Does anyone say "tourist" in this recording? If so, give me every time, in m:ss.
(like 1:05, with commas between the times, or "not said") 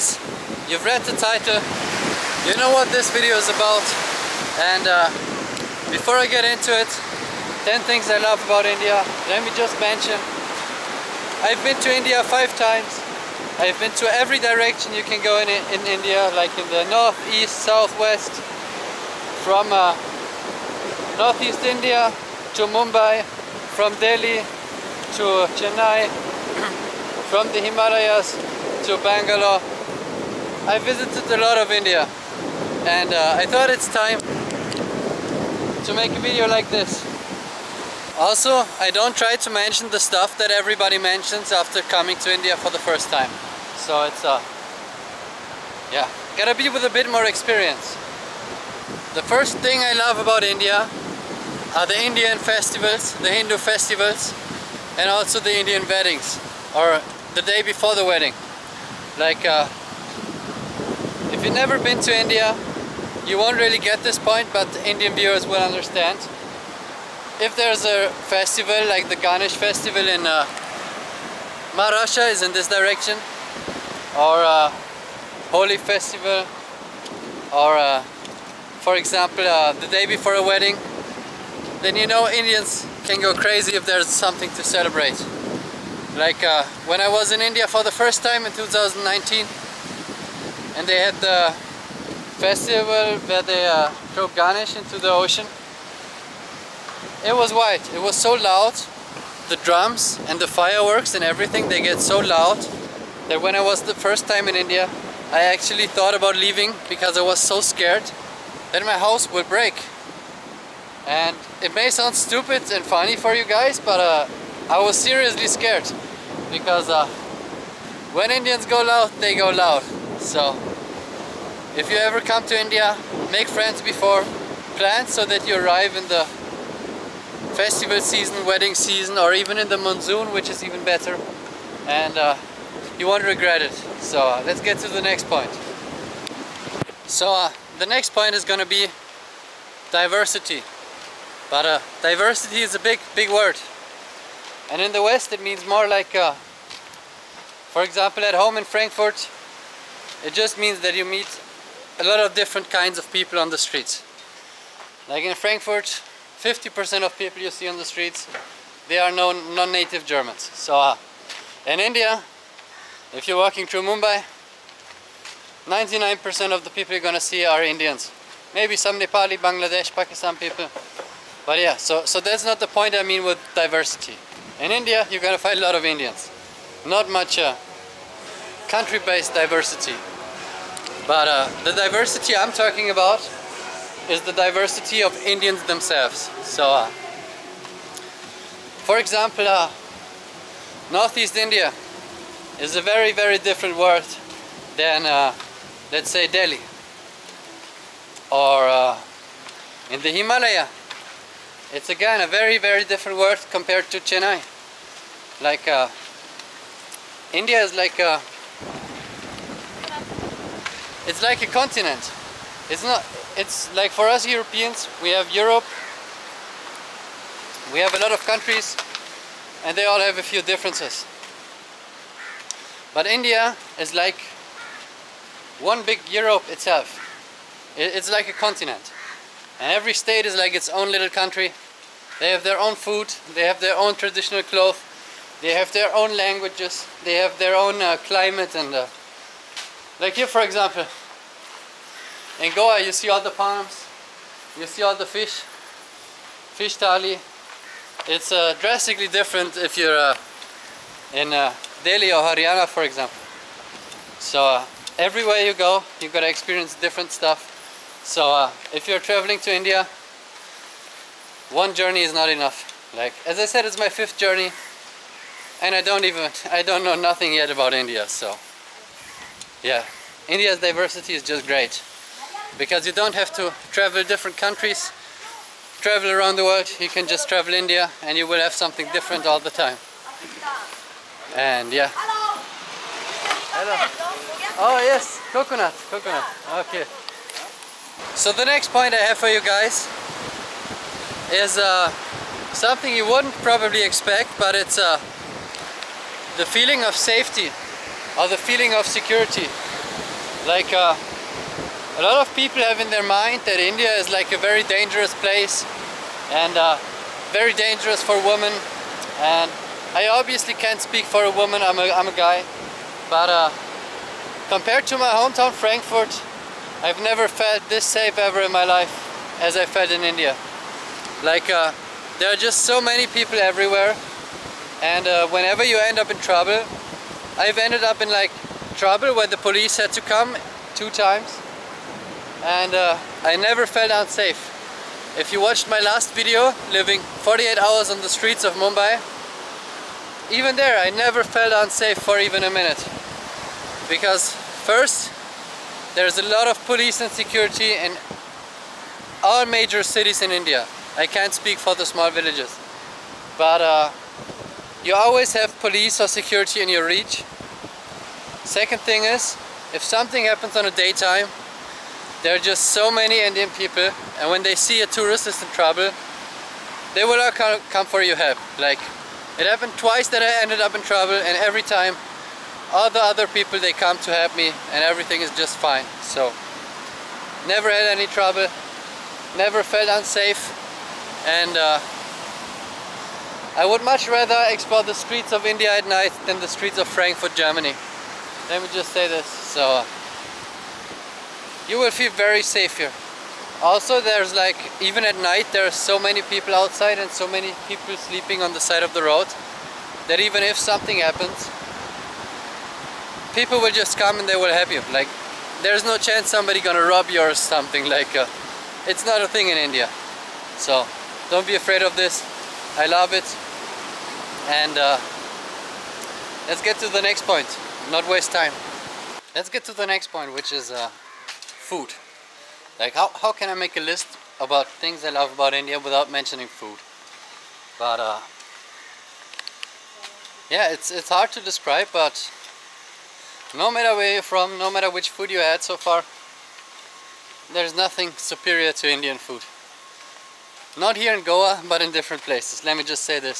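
6:04.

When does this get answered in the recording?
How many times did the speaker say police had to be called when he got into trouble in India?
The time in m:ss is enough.
5:30.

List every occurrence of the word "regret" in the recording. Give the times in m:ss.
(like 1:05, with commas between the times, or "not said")
2:13.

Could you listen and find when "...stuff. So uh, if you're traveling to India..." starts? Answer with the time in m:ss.
4:17.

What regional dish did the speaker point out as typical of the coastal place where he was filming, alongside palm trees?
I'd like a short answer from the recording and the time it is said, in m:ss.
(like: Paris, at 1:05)
Fish thali, at 4:06.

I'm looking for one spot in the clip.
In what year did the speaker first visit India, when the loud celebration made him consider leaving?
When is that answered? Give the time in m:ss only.
1:28.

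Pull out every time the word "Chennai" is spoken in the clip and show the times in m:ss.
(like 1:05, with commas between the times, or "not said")
0:25, 3:24.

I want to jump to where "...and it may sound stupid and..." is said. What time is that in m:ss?
1:51.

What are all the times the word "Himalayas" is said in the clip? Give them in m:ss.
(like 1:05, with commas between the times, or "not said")
0:27, 3:20.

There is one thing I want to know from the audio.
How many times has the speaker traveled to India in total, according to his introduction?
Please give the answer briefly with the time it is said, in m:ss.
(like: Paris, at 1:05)
5, at 0:12.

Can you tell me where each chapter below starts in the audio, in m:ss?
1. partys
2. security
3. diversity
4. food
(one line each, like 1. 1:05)
1. 0:47
2. 4:46
3. 2:16
4. 6:59.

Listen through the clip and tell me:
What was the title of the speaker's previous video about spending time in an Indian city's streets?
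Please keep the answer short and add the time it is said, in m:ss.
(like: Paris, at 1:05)
Living 48 hours on the streets of Mumbai, at 5:36.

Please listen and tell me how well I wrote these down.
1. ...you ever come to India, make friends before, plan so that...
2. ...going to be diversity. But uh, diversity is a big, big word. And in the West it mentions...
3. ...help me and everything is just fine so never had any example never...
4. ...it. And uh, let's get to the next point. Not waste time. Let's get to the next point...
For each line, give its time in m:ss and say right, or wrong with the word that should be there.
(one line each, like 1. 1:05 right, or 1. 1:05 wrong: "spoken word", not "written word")
1. 2:01 right
2. 2:18 wrong: "means", not "mentions"
3. 6:14 wrong: "trouble", not "example"
4. 6:53 right.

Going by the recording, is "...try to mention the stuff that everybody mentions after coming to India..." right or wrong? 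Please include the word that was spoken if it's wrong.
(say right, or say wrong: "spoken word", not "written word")
right.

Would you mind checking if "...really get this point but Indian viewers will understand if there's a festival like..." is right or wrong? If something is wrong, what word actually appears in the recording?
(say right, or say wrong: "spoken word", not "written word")
right.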